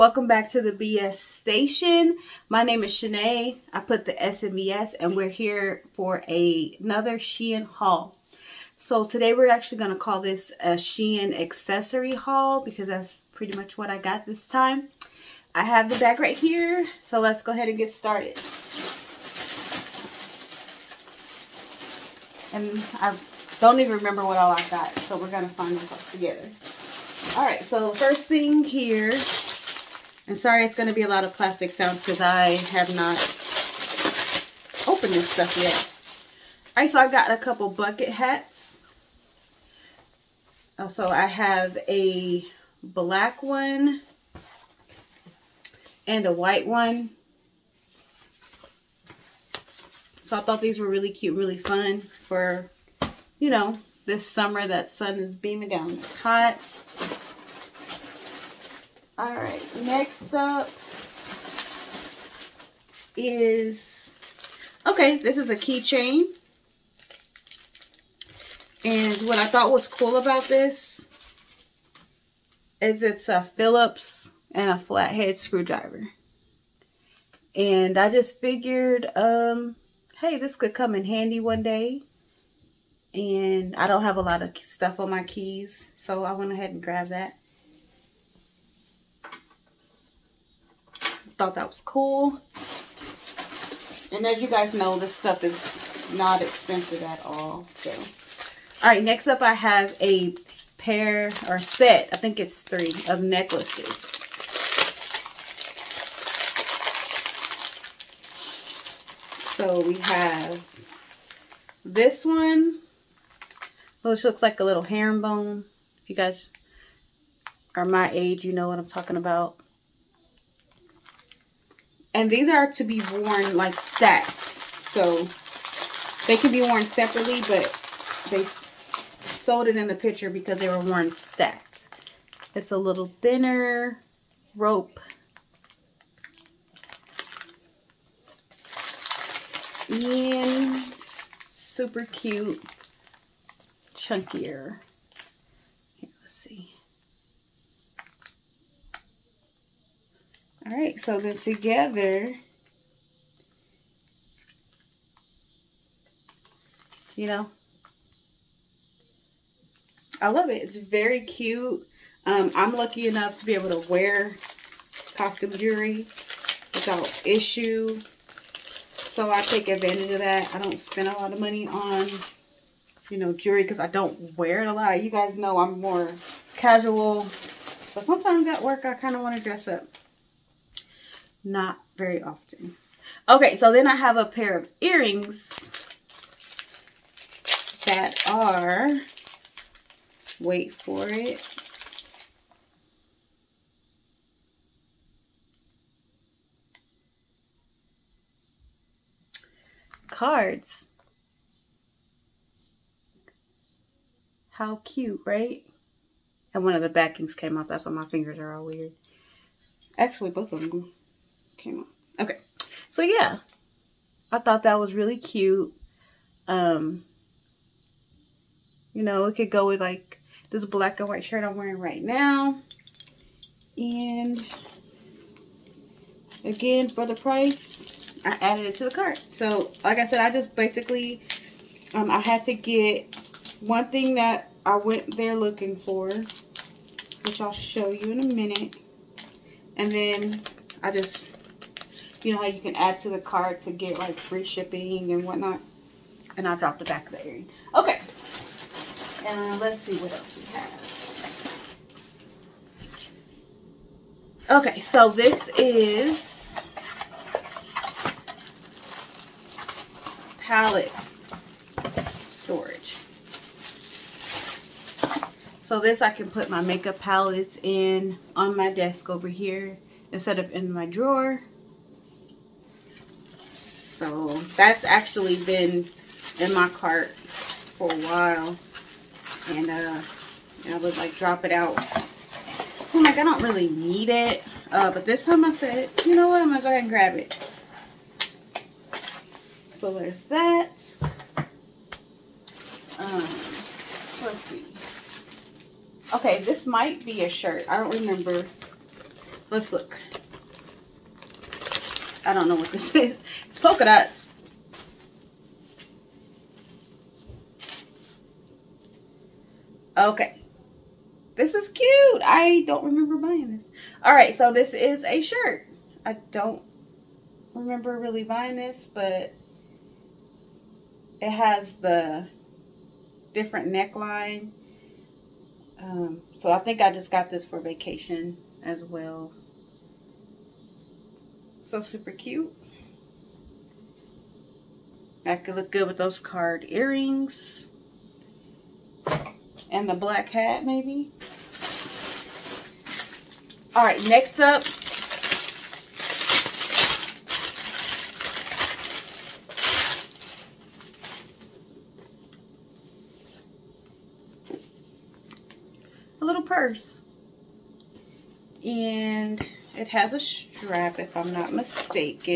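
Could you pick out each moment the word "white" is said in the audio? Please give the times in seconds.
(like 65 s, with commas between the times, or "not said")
46 s, 221 s.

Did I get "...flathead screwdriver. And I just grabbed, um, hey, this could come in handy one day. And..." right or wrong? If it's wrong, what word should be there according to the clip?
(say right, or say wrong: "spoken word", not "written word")
wrong: "figured", not "grabbed".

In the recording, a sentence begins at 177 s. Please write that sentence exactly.
But sometimes at work I kind of want to dress up not very often.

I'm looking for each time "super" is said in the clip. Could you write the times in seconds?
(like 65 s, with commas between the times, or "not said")
141 s, 331 s.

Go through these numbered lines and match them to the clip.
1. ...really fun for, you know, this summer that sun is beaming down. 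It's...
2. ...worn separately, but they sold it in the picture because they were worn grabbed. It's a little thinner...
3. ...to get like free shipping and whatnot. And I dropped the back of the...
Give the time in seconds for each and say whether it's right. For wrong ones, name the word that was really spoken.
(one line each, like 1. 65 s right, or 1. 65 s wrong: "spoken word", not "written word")
1. 51 s right
2. 126 s wrong: "stacked", not "grabbed"
3. 243 s right.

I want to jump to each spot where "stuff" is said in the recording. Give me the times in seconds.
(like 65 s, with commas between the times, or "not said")
35 s, 84 s, 95 s.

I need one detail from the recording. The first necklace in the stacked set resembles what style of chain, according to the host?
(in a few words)
herringbone.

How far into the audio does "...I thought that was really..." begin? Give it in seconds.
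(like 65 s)
214 s.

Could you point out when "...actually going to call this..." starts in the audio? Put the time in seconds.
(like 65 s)
9 s.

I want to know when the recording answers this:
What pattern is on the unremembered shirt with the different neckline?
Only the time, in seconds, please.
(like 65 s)
303 s.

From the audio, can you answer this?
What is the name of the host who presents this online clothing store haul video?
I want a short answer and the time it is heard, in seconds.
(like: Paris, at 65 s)
Shanae, at 2 s.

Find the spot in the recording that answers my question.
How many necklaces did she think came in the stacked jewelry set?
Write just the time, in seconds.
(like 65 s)
102 s.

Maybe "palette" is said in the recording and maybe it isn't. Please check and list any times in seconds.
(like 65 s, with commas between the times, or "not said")
260 s, 266 s.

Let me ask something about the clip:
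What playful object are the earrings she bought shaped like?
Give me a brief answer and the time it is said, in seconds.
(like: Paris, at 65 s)
cards, at 200 s.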